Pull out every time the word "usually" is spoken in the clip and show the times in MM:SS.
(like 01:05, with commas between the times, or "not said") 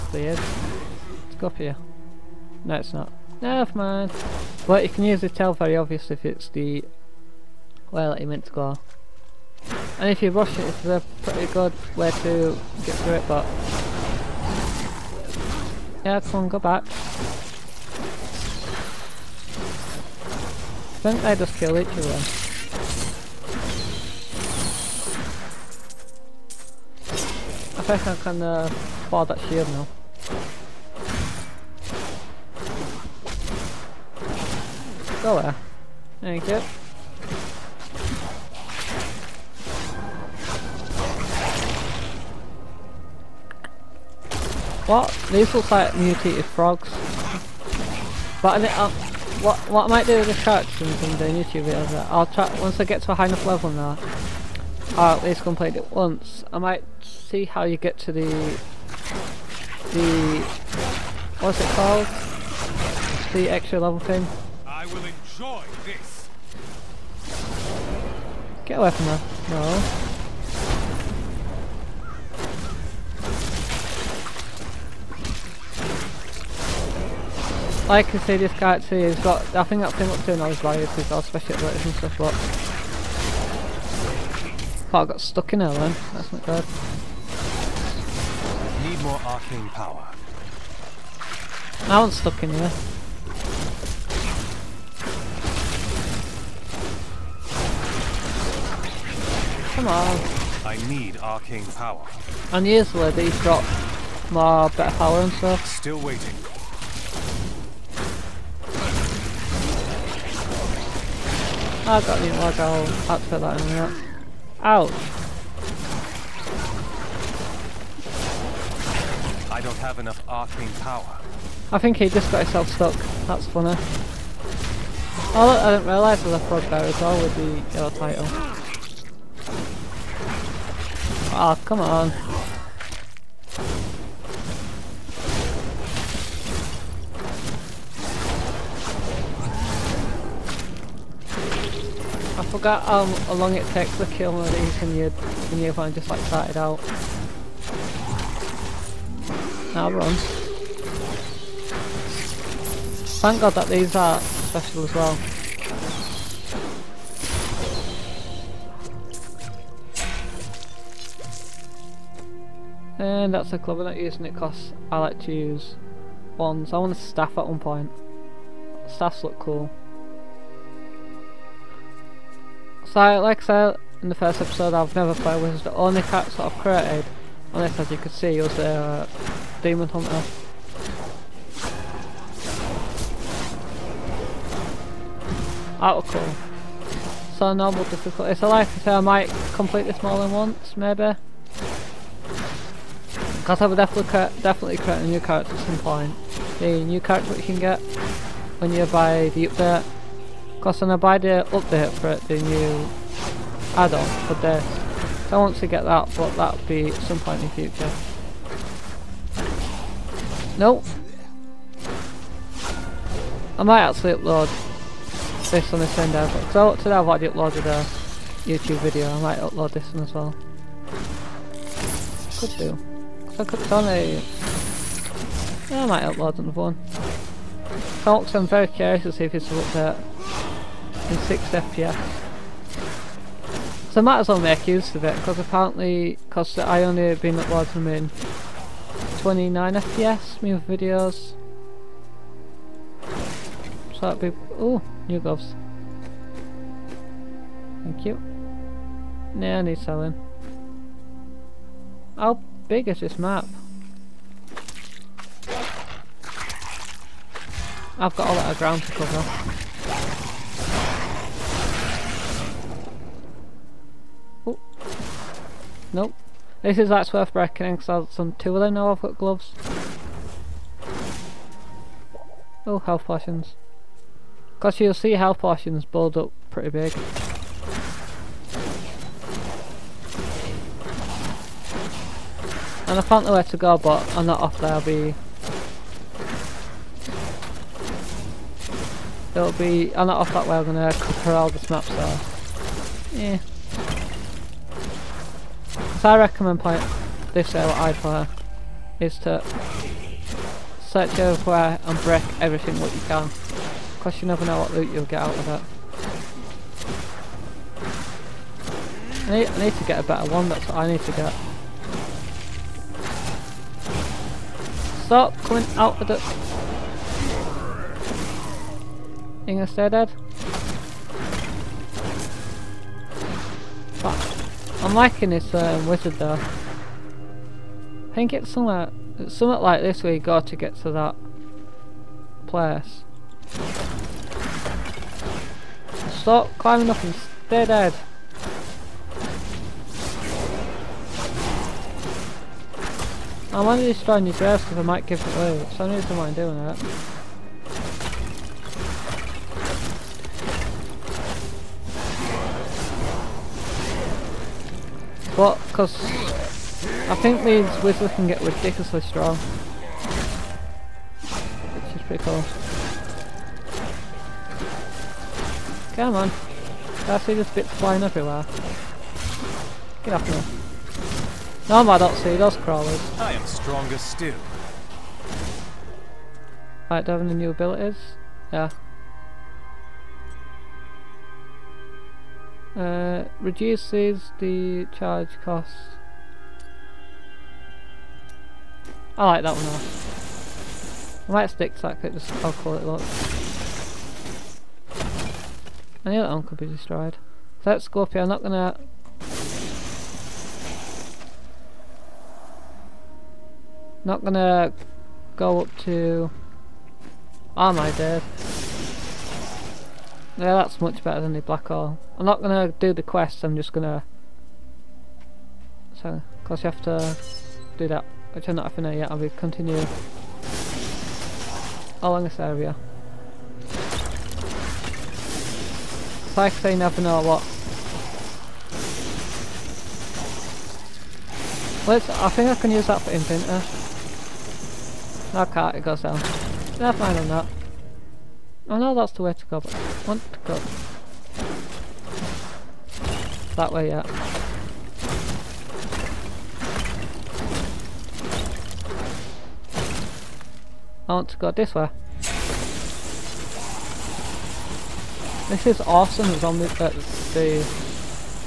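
01:42.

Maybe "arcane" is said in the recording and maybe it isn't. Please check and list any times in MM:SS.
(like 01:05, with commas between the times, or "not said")
01:29, 01:41, 02:00.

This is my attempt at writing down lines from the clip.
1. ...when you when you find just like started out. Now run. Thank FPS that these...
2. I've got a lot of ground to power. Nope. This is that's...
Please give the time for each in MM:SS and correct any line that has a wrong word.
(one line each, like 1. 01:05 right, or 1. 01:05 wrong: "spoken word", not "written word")
1. 02:24 wrong: "God", not "FPS"
2. 04:17 wrong: "cover", not "power".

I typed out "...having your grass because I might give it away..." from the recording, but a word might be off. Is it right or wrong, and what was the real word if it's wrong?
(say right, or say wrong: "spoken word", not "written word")
wrong: "destroying", not "having".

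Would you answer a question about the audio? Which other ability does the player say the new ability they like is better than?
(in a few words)
black hole.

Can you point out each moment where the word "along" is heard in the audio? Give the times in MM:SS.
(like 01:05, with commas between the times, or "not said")
07:02.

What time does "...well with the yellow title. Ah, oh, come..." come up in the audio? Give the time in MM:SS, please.
02:07.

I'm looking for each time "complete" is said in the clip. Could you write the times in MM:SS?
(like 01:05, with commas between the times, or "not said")
00:55, 03:09.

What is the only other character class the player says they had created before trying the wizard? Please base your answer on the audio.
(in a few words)
Demon Hunter.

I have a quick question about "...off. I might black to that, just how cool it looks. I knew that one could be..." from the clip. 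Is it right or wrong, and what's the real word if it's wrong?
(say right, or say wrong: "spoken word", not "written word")
wrong: "stick", not "black".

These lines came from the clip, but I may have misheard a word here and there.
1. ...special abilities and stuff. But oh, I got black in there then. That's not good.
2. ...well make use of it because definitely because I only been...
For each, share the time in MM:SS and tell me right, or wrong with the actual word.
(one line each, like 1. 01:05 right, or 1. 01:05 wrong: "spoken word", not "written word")
1. 01:21 wrong: "stuck", not "black"
2. 03:54 wrong: "apparently", not "definitely".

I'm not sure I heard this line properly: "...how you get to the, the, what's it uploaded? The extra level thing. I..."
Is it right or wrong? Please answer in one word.
wrong.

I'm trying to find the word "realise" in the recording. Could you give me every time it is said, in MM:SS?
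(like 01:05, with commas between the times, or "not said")
02:05.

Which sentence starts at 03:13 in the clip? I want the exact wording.
Because I would definitely, definitely create a new character at some point.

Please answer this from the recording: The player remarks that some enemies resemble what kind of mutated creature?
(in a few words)
frogs.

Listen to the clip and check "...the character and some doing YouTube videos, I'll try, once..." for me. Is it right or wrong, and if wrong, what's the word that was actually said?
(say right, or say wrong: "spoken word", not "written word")
right.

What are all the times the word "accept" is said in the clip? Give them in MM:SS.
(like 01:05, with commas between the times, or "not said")
01:52.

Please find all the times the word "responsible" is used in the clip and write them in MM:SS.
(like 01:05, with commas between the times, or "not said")
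not said.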